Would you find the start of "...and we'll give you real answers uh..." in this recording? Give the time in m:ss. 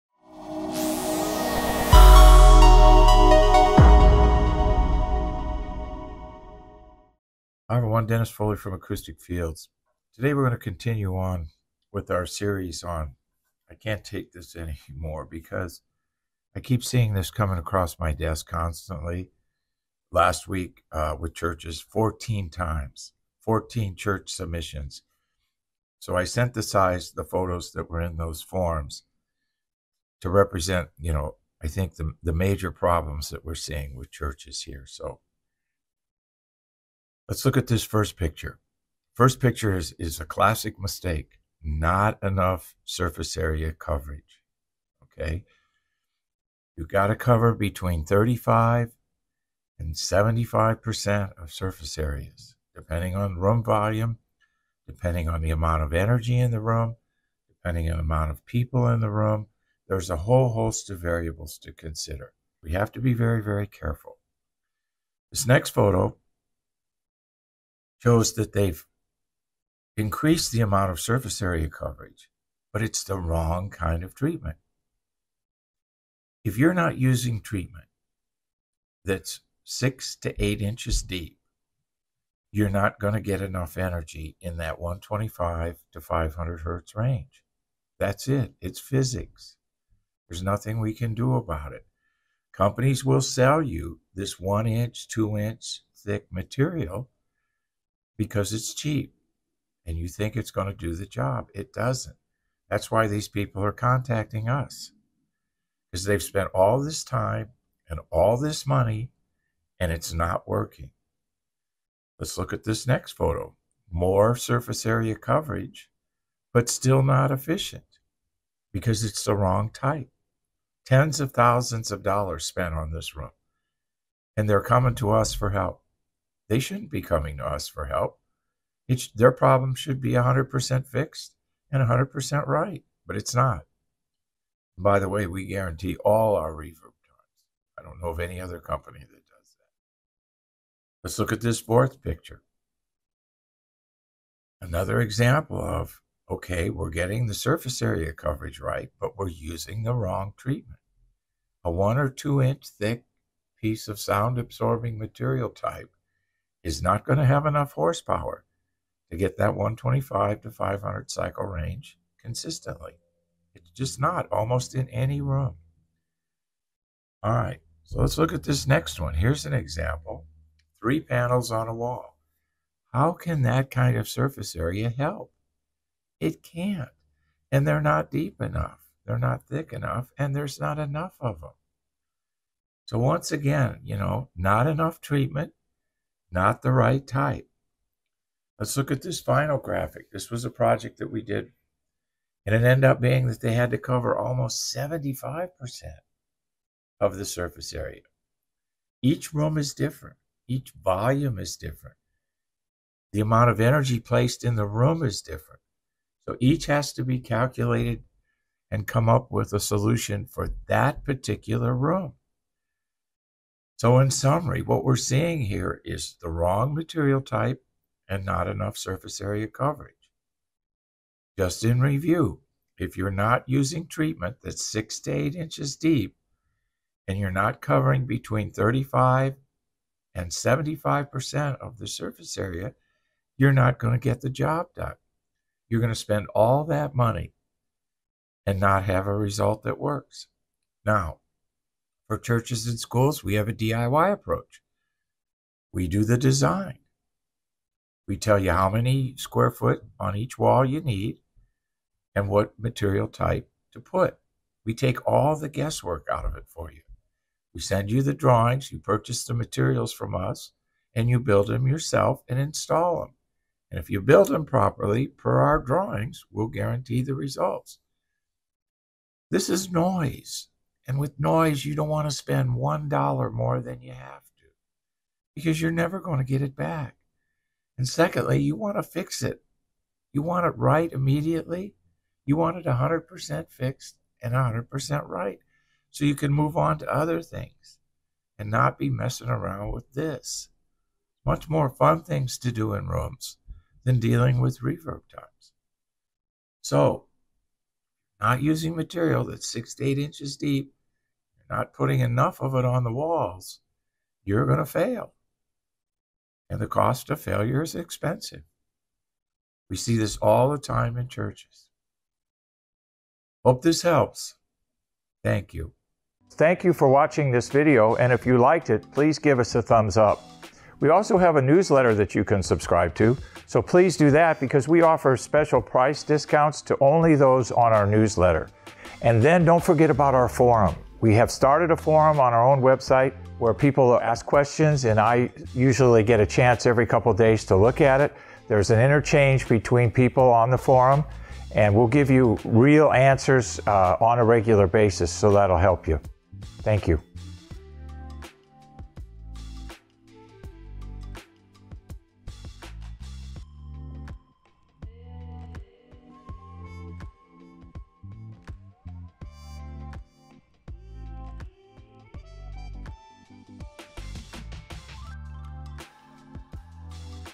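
5:41.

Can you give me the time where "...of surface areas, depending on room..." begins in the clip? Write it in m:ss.
0:51.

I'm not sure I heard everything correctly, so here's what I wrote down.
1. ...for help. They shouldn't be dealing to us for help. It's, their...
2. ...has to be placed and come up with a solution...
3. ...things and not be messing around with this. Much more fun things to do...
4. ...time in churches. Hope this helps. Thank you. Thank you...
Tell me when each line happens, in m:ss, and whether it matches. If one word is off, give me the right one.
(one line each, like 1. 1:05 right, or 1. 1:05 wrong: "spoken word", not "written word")
1. 2:05 wrong: "coming", not "dealing"
2. 3:26 wrong: "calculated", not "placed"
3. 4:47 right
4. 5:10 right.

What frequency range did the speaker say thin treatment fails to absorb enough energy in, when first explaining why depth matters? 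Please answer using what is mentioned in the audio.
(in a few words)
125 to 500 hertz.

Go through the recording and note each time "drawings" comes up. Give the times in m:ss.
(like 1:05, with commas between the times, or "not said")
4:18, 4:25.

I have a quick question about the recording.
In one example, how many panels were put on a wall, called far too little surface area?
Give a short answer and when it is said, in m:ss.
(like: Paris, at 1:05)
3, at 2:50.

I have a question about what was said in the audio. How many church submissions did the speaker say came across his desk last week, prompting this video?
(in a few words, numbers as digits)
14.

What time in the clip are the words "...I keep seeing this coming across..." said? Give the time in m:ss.
0:16.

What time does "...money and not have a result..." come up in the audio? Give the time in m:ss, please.
3:56.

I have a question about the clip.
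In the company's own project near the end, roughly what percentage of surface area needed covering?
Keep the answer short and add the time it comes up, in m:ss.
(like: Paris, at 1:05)
75%, at 3:14.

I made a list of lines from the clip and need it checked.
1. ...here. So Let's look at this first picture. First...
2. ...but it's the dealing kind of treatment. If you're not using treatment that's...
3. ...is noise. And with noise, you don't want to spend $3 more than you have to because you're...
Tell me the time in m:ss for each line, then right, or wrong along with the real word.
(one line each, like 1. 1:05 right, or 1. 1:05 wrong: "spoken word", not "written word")
1. 0:34 right
2. 1:12 wrong: "wrong", not "dealing"
3. 4:29 wrong: "1", not "3".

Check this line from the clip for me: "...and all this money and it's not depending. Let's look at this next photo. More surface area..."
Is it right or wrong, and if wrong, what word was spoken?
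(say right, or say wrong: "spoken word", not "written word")
wrong: "working", not "depending".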